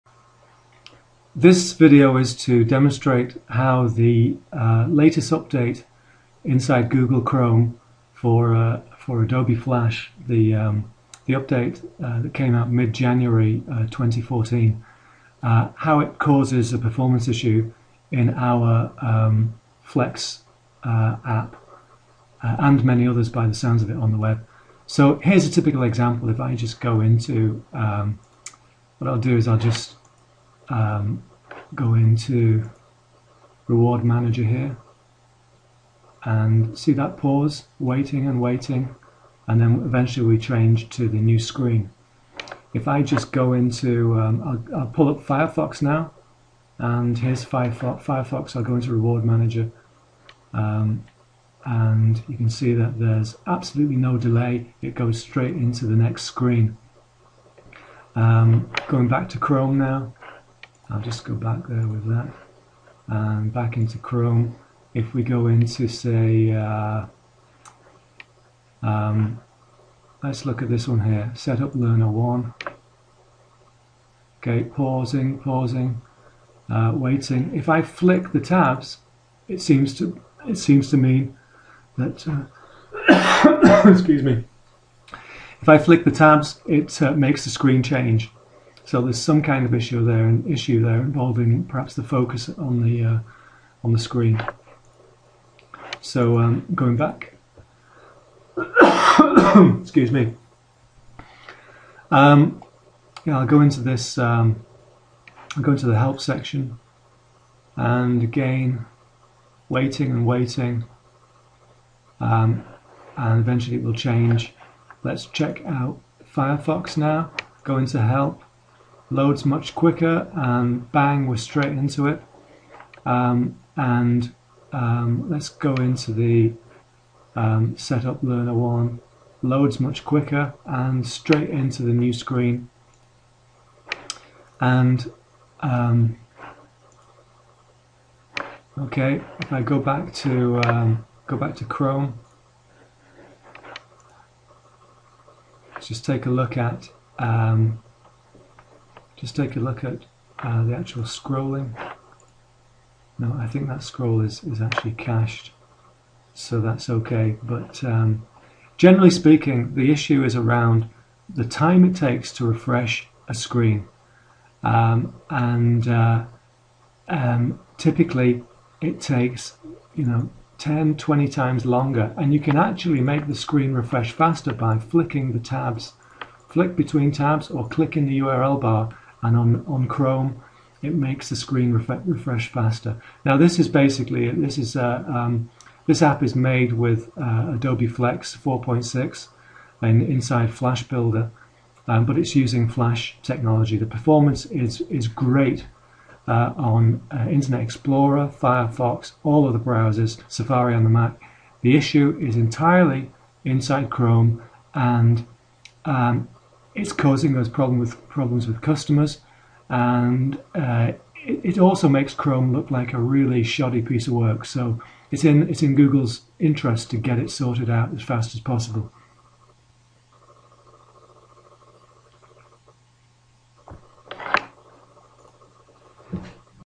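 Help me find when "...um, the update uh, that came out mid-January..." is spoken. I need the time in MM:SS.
00:10.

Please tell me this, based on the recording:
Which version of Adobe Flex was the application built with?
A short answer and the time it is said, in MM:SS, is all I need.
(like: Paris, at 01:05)
4.6, at 03:08.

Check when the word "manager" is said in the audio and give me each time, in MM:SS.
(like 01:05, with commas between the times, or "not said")
00:34, 00:49.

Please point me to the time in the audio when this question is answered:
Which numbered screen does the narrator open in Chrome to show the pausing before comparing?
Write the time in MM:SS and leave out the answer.
01:11.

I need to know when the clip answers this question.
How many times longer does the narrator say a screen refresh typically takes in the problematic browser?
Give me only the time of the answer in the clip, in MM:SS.
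02:50.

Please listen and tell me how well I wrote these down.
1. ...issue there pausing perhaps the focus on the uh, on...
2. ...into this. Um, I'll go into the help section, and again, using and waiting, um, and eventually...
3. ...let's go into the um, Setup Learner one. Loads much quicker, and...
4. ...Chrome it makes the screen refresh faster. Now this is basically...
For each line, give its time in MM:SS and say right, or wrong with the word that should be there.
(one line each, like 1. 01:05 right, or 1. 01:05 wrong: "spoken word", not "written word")
1. 01:30 wrong: "involving", not "pausing"
2. 01:43 wrong: "waiting", not "using"
3. 02:05 right
4. 02:59 right.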